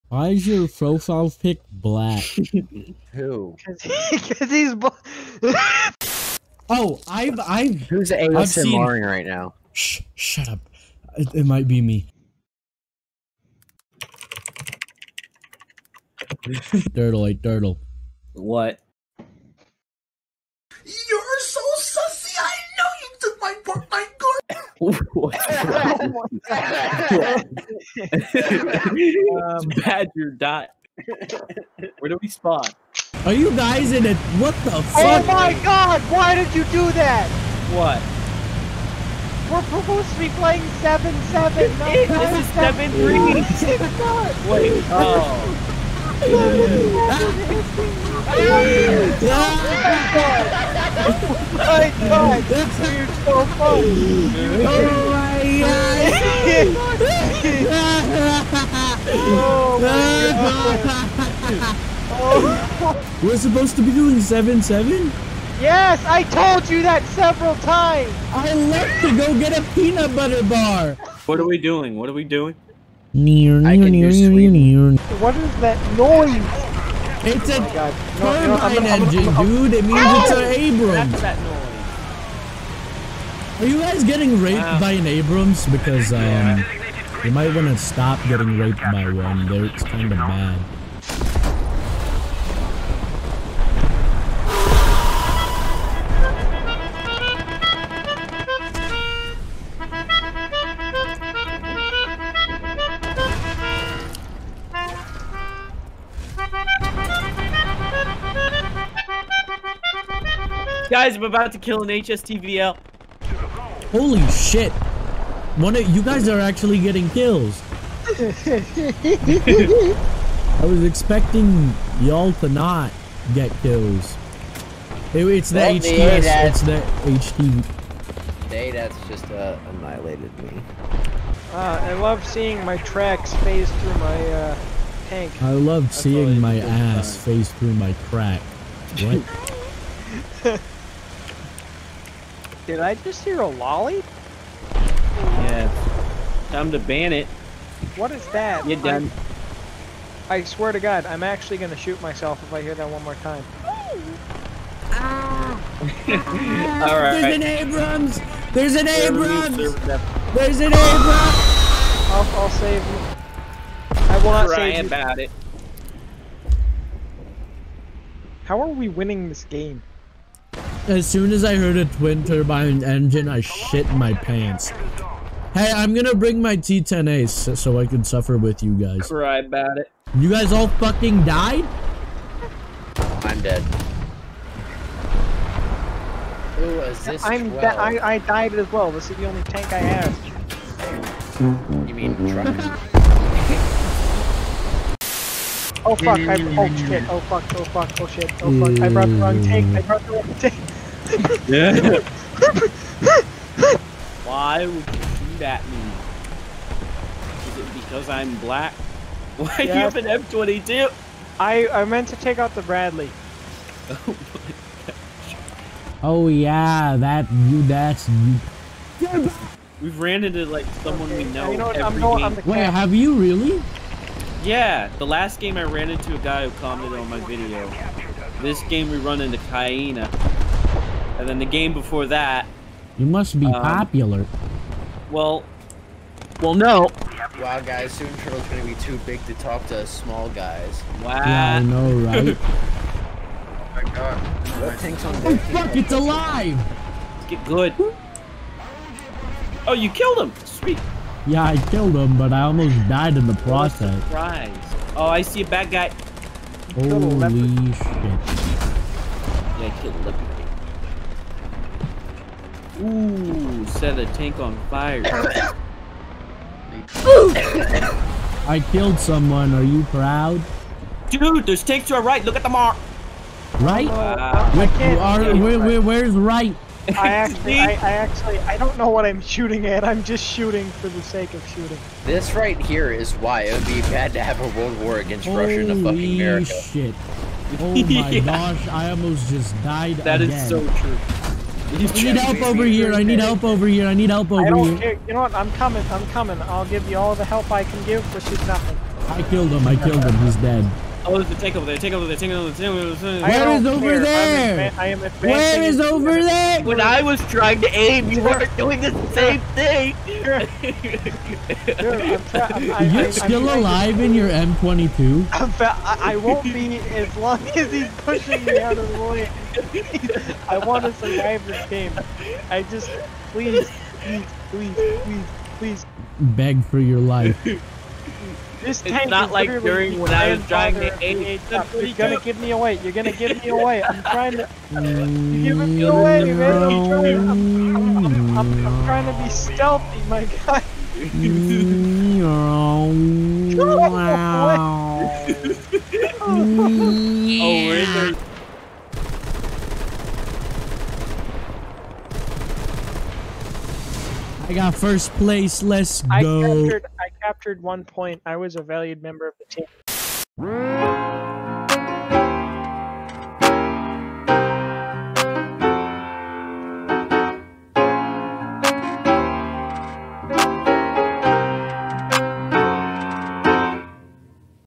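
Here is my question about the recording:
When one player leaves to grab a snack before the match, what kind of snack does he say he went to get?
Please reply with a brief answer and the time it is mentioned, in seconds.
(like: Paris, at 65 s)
peanut butter bar, at 69 s.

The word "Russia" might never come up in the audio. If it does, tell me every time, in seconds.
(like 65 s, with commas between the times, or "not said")
285 s.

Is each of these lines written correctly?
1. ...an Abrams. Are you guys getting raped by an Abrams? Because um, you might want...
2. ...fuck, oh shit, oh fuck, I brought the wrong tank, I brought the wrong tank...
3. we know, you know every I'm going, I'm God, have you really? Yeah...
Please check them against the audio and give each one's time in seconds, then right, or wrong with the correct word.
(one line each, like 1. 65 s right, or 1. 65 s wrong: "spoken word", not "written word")
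1. 80 s right
2. 197 s right
3. 221 s wrong: "Wait", not "God".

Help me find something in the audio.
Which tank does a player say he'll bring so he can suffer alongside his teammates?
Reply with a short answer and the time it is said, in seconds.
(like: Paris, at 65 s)
T10A, at 176 s.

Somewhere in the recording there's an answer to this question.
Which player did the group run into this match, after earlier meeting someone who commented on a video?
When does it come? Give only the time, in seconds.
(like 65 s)
229 s.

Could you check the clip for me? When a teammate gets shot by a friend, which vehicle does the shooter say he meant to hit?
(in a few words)
Bradley.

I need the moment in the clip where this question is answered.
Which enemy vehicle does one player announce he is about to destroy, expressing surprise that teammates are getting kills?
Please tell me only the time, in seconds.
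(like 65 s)
111 s.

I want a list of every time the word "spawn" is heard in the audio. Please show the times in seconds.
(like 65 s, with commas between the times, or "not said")
32 s.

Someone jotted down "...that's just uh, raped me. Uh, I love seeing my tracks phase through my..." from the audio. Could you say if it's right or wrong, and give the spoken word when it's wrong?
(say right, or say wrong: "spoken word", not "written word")
wrong: "annihilated", not "raped".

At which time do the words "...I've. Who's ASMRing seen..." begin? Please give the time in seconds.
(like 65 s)
7 s.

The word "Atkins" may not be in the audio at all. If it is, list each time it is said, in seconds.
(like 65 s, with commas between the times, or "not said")
not said.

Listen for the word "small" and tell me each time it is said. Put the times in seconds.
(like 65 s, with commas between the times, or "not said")
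239 s.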